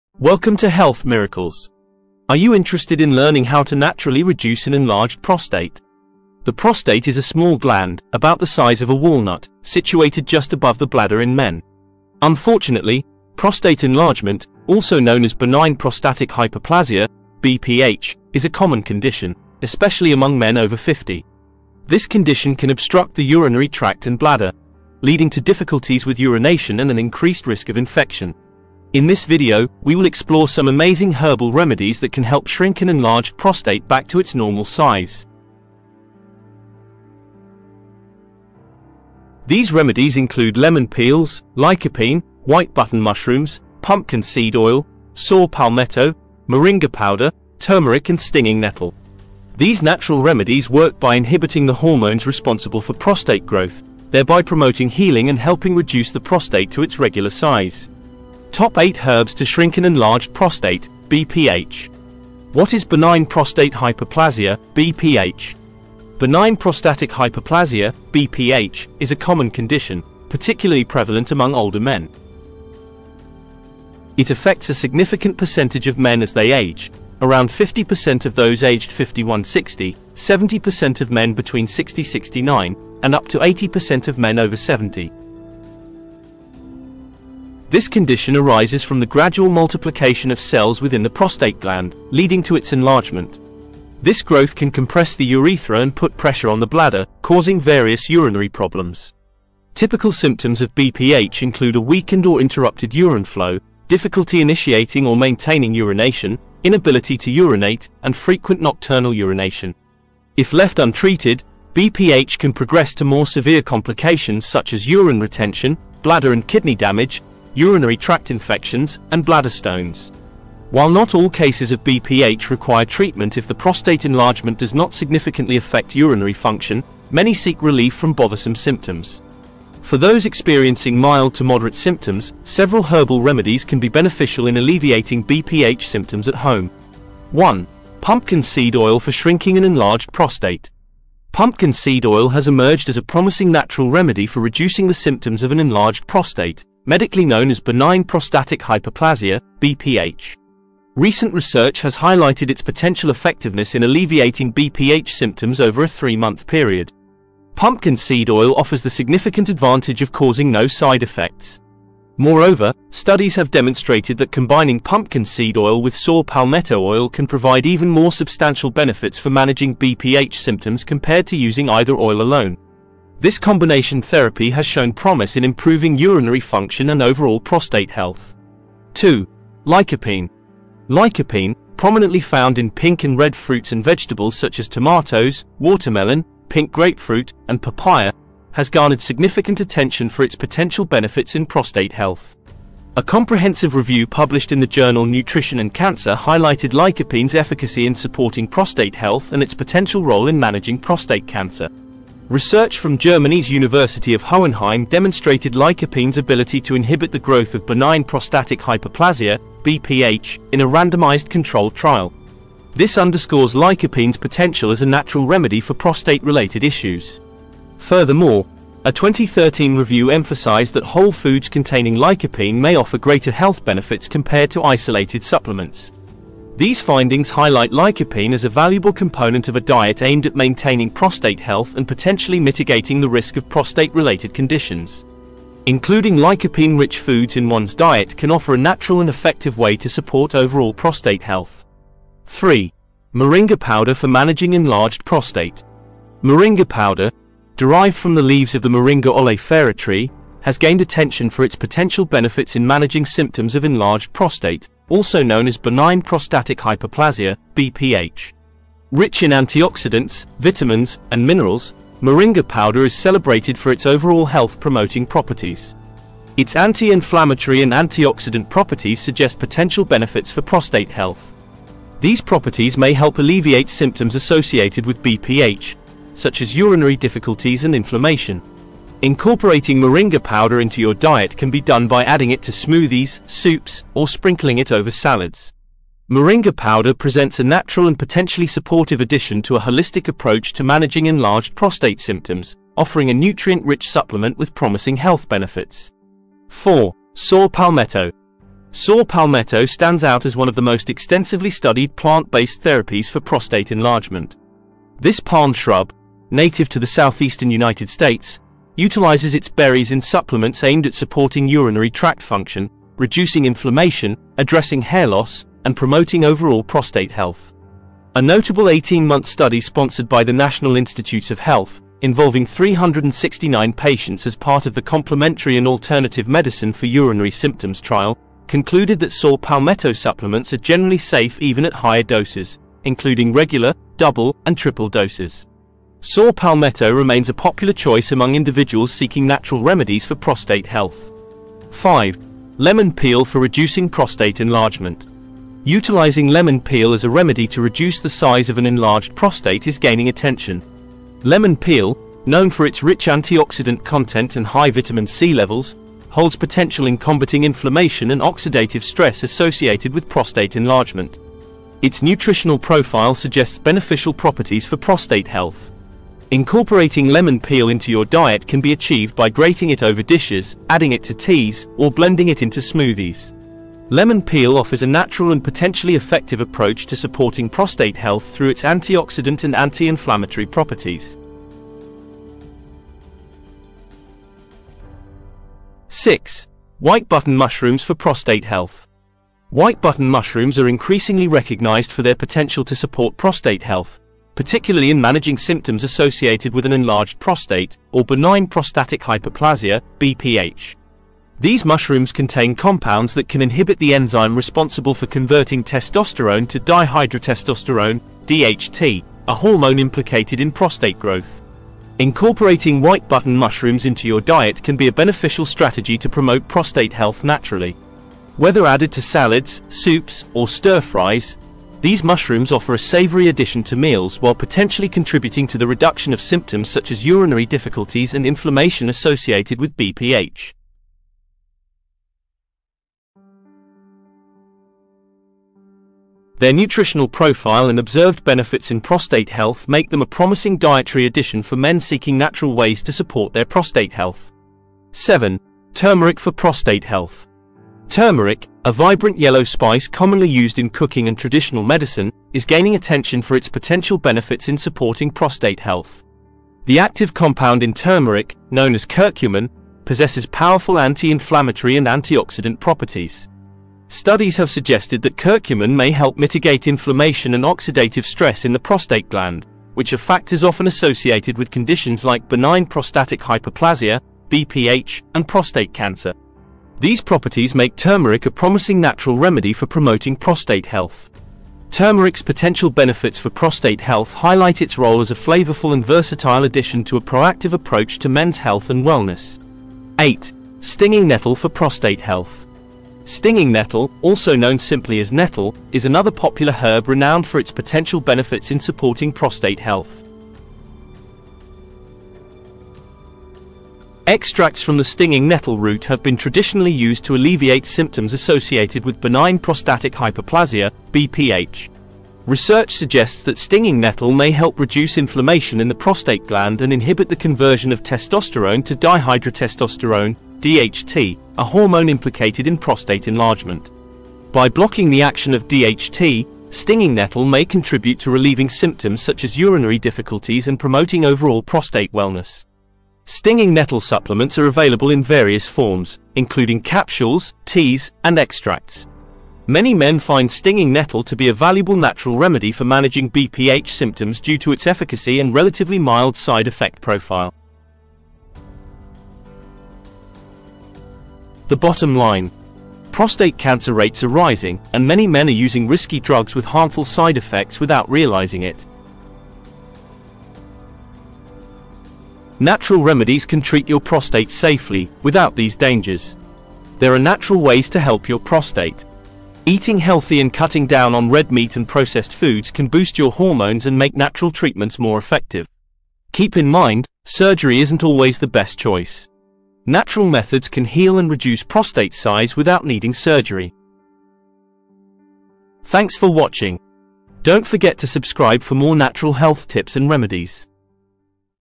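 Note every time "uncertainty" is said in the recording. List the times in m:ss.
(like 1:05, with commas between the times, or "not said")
not said.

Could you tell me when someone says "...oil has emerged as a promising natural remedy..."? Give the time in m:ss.
2:22.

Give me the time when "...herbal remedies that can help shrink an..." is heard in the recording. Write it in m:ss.
0:31.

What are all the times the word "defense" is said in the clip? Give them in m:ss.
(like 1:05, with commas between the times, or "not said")
not said.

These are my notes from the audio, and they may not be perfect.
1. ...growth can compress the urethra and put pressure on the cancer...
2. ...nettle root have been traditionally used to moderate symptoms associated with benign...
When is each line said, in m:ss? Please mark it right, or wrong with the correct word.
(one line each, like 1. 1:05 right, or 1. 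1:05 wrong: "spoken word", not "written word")
1. 1:34 wrong: "bladder", not "cancer"
2. 8:25 wrong: "alleviate", not "moderate".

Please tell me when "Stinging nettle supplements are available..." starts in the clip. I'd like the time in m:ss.
8:53.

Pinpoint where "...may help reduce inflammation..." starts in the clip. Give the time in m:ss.
8:34.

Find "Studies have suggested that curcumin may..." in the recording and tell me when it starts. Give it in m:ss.
7:43.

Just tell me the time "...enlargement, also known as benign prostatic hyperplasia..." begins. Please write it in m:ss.
0:13.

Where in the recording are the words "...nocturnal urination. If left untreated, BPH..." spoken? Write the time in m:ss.
1:48.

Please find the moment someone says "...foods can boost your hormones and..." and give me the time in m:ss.
9:32.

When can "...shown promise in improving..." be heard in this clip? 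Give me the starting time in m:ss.
2:54.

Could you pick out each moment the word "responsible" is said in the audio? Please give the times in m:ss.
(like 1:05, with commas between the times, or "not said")
0:52, 6:44.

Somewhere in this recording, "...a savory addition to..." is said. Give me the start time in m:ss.
7:02.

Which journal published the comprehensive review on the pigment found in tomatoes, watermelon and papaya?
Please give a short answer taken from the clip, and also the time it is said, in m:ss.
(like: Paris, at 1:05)
Nutrition and Cancer, at 3:15.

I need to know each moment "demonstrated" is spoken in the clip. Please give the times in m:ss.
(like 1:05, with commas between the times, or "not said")
2:43, 3:24.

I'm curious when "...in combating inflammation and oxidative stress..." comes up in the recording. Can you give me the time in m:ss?
5:56.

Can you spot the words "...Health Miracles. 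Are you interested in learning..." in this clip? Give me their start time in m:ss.
0:00.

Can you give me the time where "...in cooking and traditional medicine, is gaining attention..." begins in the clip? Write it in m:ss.
7:30.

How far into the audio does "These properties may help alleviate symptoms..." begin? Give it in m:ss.
4:31.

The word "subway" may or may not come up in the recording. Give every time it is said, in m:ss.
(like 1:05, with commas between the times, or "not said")
not said.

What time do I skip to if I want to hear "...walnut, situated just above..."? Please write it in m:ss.
0:08.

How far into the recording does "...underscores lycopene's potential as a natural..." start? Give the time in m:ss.
3:32.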